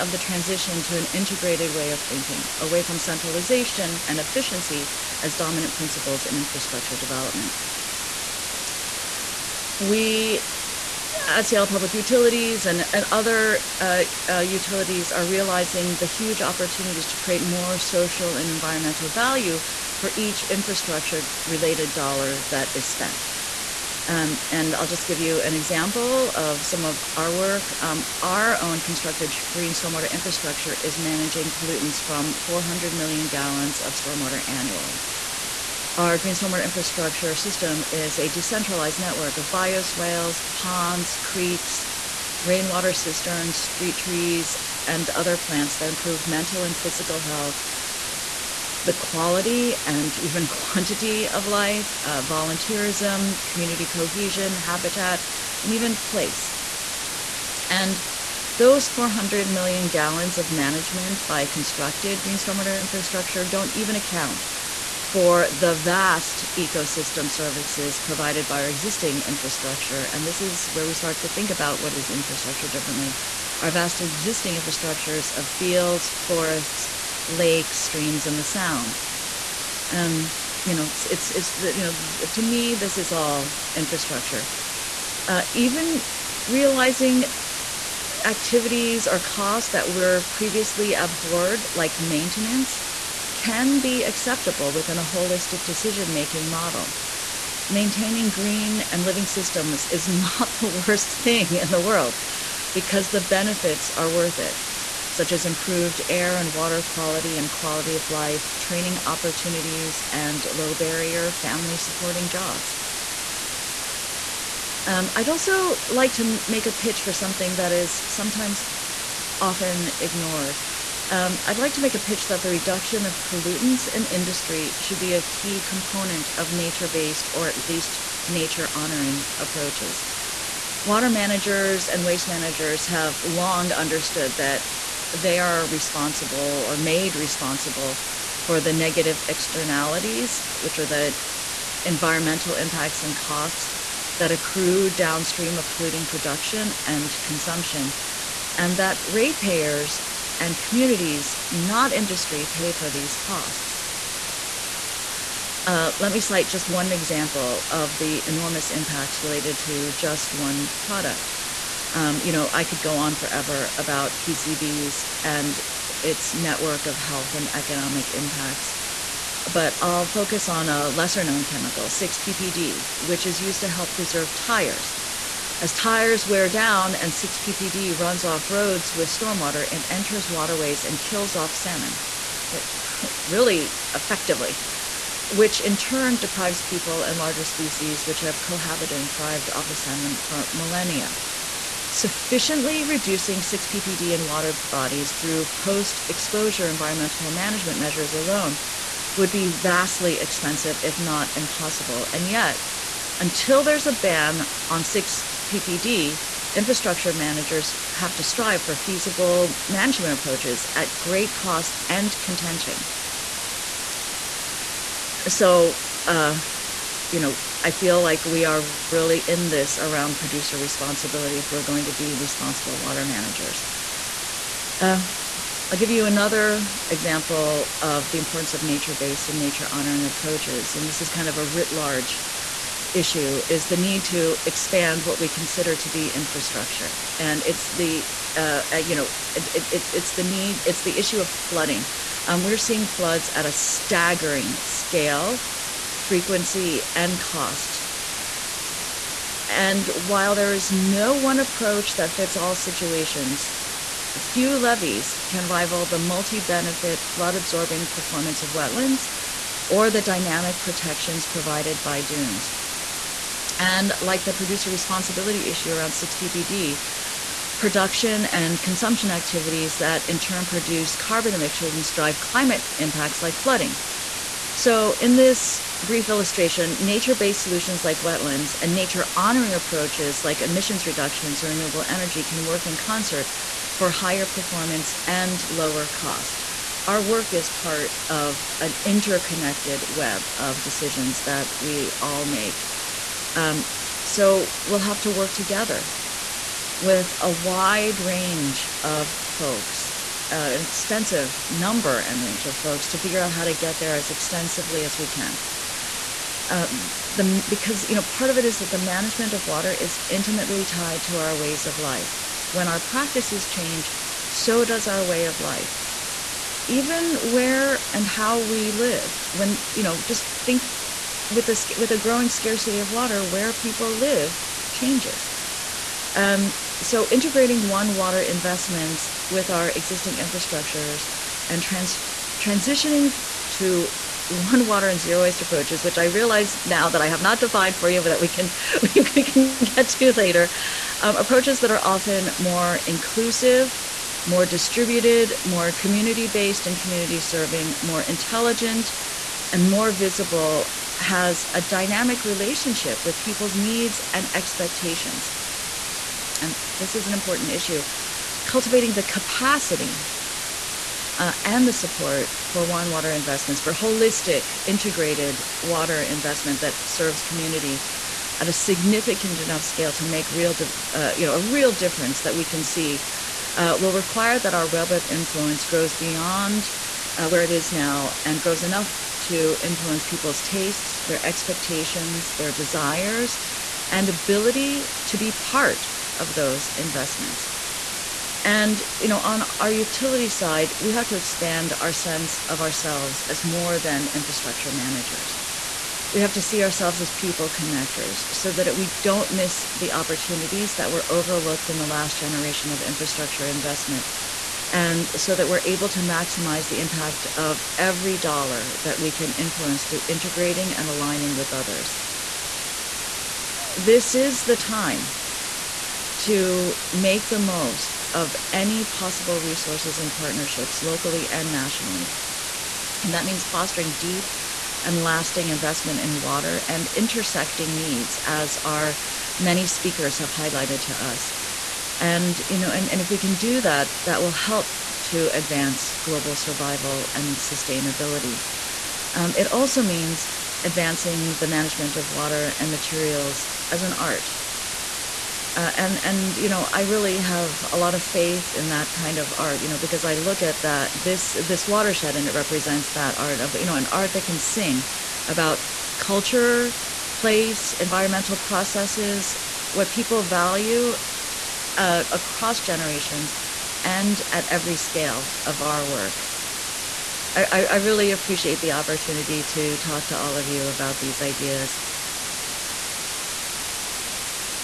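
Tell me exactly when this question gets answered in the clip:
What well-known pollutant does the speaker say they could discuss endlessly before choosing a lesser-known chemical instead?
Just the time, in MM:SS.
02:44.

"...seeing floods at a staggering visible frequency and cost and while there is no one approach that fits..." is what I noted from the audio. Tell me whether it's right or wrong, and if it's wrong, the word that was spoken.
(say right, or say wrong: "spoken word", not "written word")
wrong: "scale", not "visible".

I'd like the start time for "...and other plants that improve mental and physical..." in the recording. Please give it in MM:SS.
00:44.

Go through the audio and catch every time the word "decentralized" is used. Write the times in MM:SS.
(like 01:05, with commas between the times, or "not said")
00:38.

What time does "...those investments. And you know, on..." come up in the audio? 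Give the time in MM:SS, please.
06:26.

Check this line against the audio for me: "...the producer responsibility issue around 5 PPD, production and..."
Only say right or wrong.
wrong.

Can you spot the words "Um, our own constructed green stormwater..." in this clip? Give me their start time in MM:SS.
00:27.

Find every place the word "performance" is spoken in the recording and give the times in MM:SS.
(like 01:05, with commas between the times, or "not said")
04:17, 04:44.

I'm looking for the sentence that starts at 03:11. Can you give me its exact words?
Sufficiently reducing 6-PPD in water bodies through post-exposure environmental management measures alone would be vastly expensive, if not impossible.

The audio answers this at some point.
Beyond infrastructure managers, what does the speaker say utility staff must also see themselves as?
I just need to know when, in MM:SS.
06:37.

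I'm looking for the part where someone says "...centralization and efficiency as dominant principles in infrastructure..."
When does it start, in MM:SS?
00:02.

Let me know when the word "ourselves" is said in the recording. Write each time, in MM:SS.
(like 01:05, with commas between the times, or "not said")
06:32, 06:36.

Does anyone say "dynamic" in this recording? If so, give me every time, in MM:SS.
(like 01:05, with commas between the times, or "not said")
04:20, 05:51.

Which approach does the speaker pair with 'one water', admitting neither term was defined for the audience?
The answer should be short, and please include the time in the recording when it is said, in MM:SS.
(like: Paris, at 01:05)
Zero waste, at 05:34.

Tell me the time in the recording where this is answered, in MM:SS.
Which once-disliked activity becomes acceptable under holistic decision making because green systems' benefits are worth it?
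01:31.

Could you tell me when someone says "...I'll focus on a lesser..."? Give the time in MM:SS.
02:49.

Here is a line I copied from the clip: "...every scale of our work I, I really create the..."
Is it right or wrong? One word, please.
wrong.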